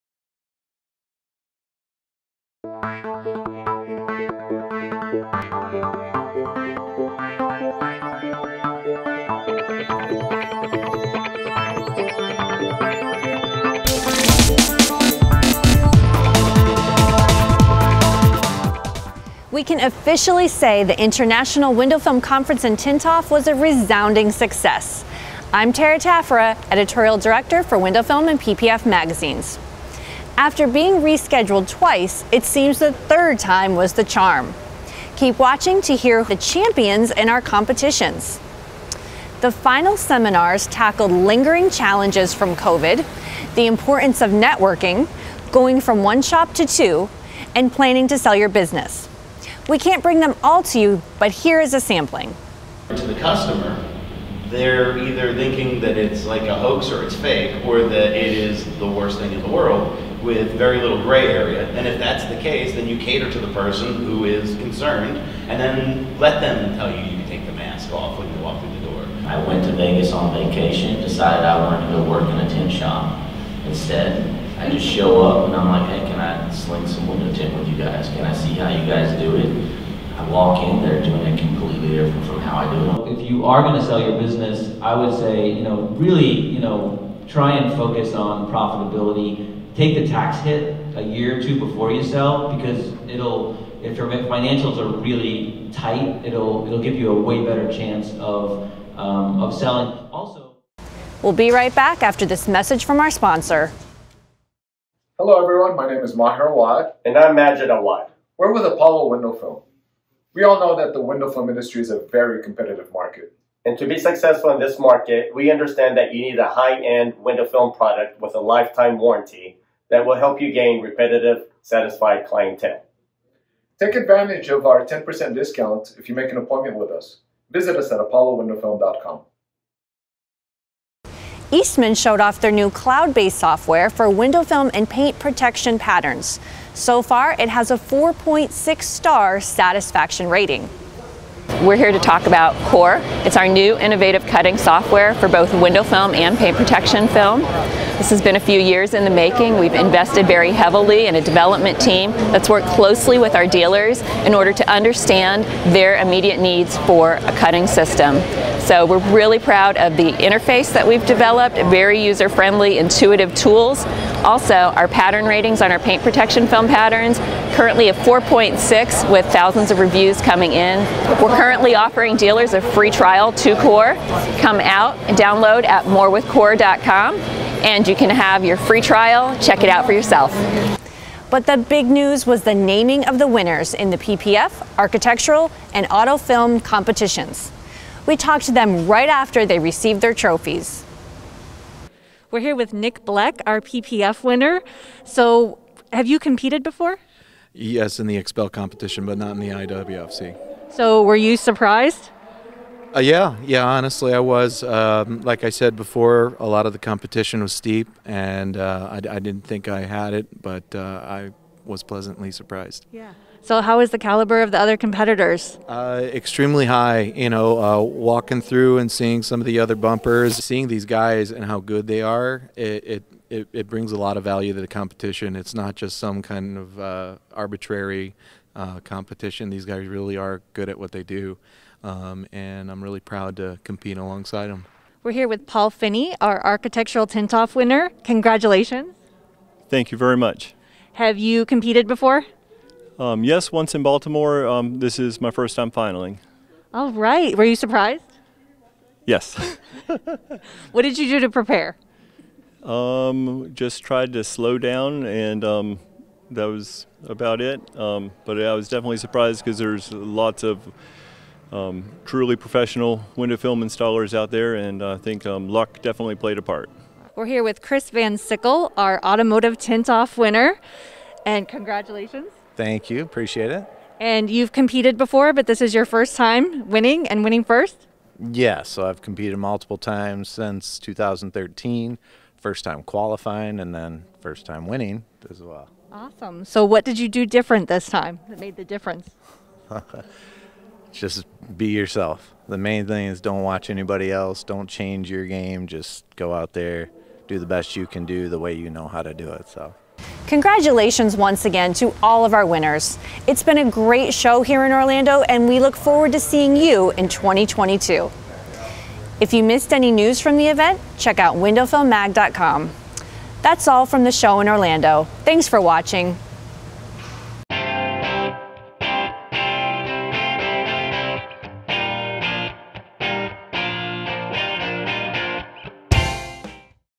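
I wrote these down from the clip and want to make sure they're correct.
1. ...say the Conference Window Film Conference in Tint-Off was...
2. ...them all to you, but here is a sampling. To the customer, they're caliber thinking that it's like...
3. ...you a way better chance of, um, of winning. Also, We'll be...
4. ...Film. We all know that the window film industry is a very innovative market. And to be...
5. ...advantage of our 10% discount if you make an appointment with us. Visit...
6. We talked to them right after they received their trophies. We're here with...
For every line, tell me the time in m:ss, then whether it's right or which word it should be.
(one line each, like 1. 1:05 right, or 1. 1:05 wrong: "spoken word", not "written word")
1. 0:20 wrong: "International", not "Conference"
2. 0:50 wrong: "either", not "caliber"
3. 1:36 wrong: "selling", not "winning"
4. 1:49 wrong: "competitive", not "innovative"
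5. 2:03 right
6. 3:08 right.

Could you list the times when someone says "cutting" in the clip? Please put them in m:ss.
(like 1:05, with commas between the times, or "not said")
2:24, 2:37.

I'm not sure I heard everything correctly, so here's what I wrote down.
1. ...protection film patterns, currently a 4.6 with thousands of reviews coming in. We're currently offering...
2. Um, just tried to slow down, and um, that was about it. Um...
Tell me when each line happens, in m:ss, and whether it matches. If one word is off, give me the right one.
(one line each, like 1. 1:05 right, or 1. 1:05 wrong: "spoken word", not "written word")
1. 2:46 right
2. 4:12 right.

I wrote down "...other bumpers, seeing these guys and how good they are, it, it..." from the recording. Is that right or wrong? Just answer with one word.
right.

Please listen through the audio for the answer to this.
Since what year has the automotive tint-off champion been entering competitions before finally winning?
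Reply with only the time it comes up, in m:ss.
4:40.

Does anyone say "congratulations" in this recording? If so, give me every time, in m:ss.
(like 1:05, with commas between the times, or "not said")
3:58, 4:31, 5:00.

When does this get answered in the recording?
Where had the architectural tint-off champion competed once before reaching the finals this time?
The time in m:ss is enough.
4:03.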